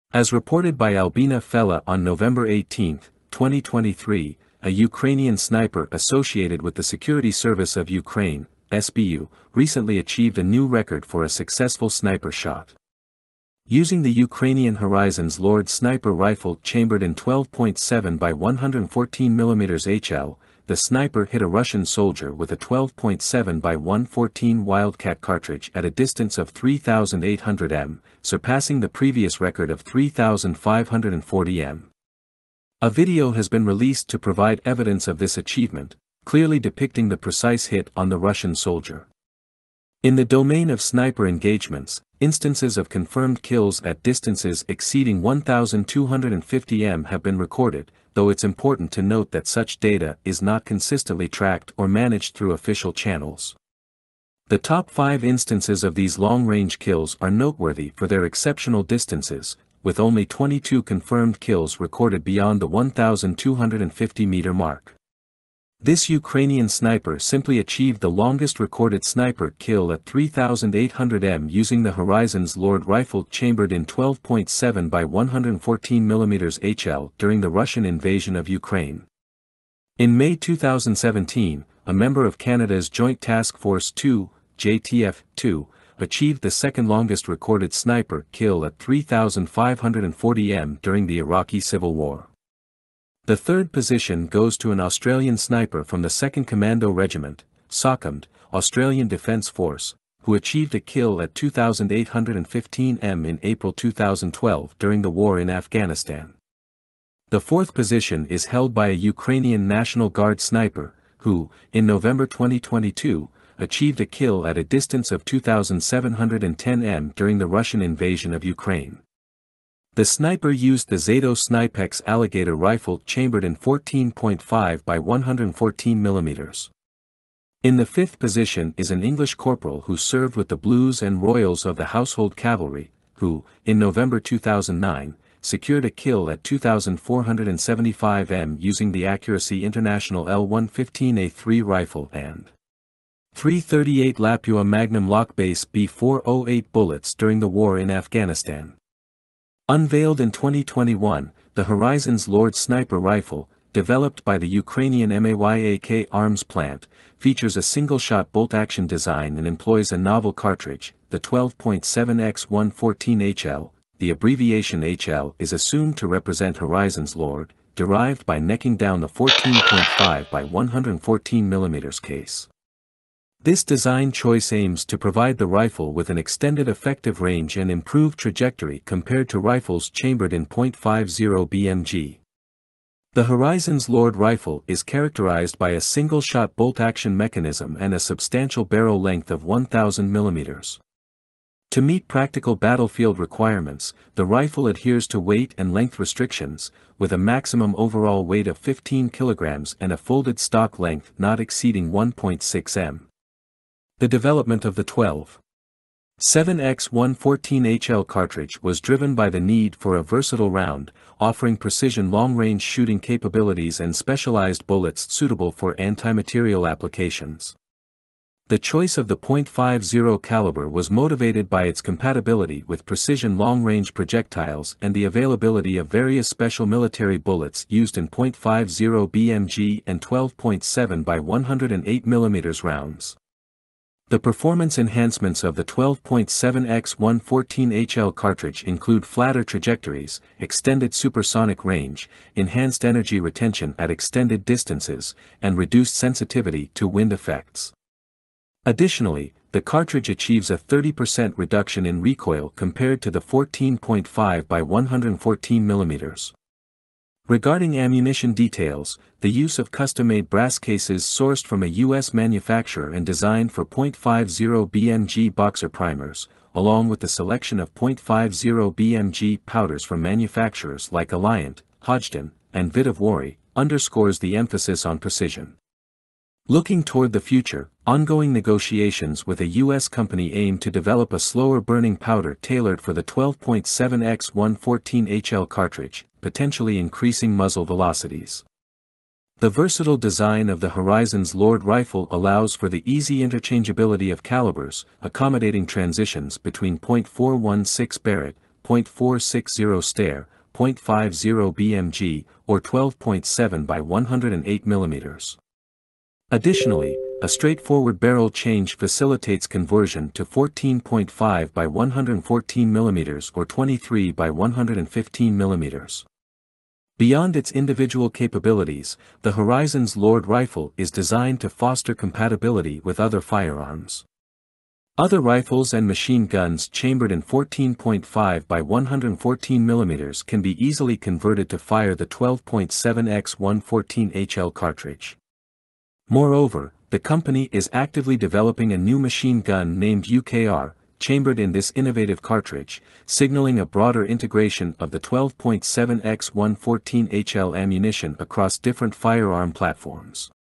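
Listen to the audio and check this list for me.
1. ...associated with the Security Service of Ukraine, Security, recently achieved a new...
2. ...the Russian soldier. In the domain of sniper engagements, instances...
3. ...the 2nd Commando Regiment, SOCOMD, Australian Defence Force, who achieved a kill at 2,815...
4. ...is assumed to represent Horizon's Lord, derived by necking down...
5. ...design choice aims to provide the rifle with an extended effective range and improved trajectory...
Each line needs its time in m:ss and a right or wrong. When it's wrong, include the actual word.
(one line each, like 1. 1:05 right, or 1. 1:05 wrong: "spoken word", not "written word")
1. 0:05 wrong: "SBU", not "Security"
2. 0:38 right
3. 1:36 right
4. 2:45 right
5. 2:53 right.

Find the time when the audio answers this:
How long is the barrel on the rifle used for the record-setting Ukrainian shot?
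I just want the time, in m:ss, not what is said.
3:09.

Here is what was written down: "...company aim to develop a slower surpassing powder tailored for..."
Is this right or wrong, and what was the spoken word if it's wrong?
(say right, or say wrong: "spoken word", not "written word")
wrong: "burning", not "surpassing".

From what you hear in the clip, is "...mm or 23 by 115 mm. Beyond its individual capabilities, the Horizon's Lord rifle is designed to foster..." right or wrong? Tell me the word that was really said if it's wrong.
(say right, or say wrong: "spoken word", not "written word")
right.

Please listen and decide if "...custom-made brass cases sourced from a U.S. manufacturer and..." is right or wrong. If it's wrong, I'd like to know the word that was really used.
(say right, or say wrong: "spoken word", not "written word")
right.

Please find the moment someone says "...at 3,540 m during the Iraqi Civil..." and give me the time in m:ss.
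1:28.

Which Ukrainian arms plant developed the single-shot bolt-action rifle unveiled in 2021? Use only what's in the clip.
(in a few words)
MAYAK.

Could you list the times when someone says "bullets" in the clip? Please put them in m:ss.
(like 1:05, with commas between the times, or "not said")
2:26, 3:34, 3:47.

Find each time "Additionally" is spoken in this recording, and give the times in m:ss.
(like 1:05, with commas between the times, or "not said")
4:08, 5:06.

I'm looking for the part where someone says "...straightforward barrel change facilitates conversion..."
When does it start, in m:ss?
5:07.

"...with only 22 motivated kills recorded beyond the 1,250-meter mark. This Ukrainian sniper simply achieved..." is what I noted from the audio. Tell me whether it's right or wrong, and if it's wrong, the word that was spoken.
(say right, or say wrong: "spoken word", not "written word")
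wrong: "confirmed", not "motivated".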